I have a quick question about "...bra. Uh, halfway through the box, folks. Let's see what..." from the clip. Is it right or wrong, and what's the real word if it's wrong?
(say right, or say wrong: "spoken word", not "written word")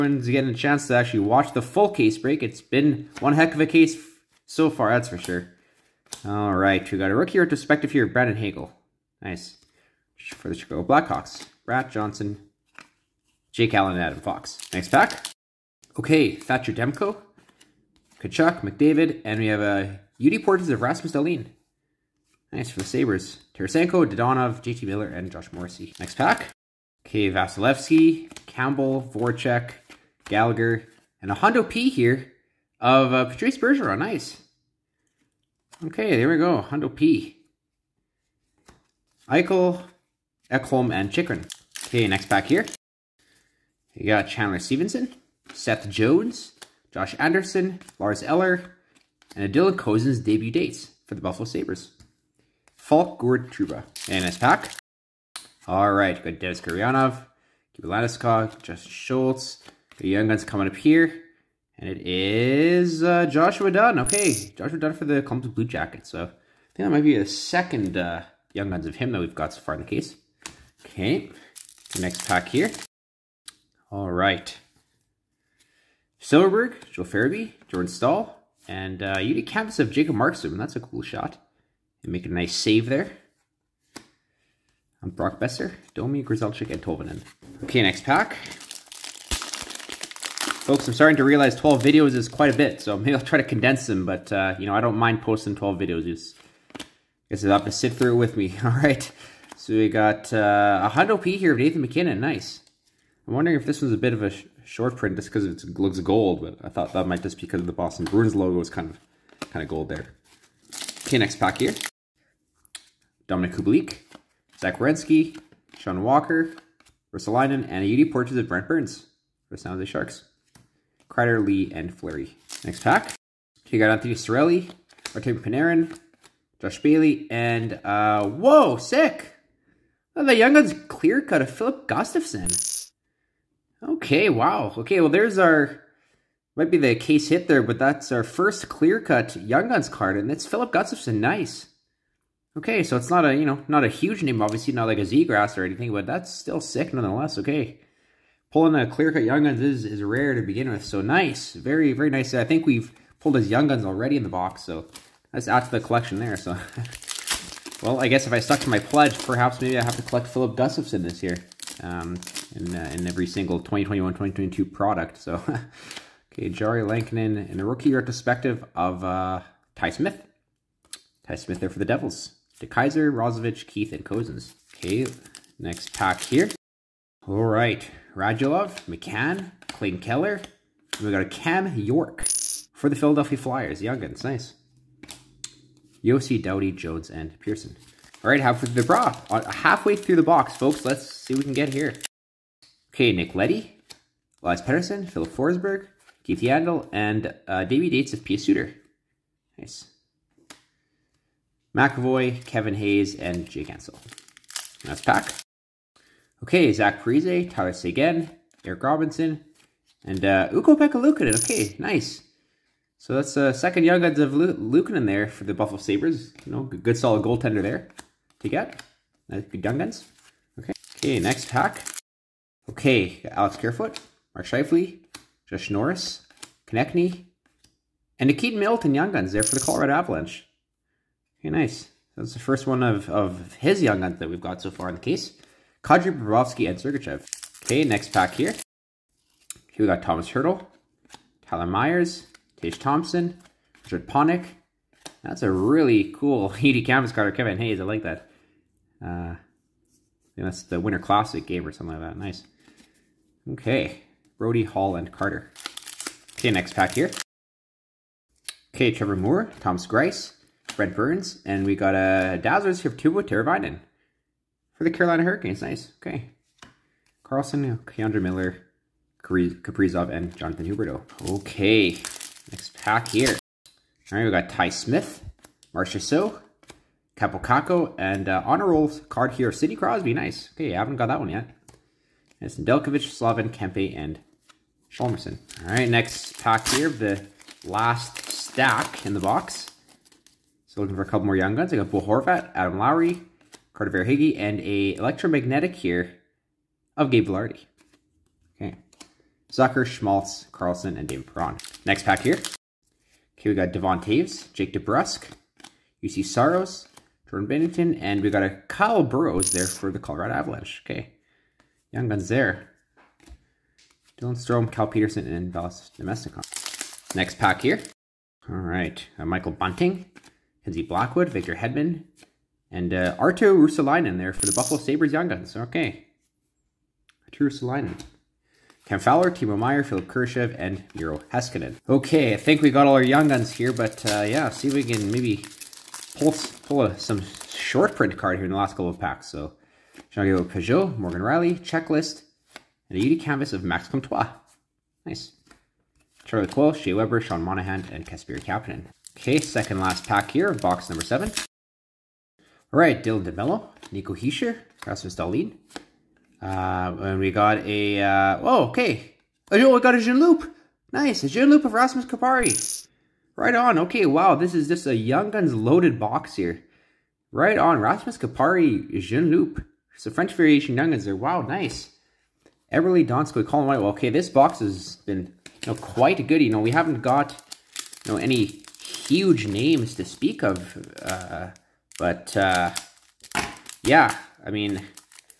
right.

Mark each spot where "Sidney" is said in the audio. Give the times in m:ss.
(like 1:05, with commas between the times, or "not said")
4:39.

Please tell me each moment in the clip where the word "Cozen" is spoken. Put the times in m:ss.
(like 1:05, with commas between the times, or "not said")
0:49, 2:54.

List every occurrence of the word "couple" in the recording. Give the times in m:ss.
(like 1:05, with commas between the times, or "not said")
4:51, 5:38.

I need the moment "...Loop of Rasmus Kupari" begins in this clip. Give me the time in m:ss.
6:01.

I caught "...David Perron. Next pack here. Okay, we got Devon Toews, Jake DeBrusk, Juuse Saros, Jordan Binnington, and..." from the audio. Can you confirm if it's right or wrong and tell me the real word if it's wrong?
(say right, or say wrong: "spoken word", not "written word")
right.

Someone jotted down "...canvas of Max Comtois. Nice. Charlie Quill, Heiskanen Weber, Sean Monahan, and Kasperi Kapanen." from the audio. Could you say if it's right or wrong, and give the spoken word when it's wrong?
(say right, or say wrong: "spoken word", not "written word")
wrong: "Shea", not "Heiskanen".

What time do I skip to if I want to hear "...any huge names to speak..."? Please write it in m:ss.
6:18.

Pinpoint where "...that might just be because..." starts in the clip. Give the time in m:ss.
1:46.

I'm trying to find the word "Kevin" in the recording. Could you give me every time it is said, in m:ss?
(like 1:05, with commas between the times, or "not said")
3:22, 4:07.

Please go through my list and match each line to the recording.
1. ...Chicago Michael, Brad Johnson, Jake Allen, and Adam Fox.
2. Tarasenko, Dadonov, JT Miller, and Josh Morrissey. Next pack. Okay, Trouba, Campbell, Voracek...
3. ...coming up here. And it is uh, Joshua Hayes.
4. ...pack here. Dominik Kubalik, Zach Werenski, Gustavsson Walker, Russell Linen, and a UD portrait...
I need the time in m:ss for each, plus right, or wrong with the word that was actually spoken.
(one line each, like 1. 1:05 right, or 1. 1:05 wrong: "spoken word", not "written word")
1. 0:10 wrong: "Blackhawks", not "Michael"
2. 0:23 wrong: "Vasilevskiy", not "Trouba"
3. 1:00 wrong: "Dunne", not "Hayes"
4. 1:51 wrong: "Sean", not "Gustavsson".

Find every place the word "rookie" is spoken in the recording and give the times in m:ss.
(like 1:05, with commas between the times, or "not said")
0:07, 2:47.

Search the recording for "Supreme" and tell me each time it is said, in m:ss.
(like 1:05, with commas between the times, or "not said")
not said.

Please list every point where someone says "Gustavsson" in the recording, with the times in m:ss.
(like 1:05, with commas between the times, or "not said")
2:11, 2:20, 2:40.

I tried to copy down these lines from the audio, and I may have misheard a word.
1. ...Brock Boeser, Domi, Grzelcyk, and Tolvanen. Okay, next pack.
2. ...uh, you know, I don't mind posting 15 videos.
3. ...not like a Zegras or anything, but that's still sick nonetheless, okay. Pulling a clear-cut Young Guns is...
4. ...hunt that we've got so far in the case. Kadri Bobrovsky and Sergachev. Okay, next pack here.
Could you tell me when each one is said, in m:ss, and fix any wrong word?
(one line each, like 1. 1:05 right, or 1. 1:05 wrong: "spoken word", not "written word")
1. 1:25 right
2. 1:34 wrong: "12", not "15"
3. 2:24 right
4. 3:54 right.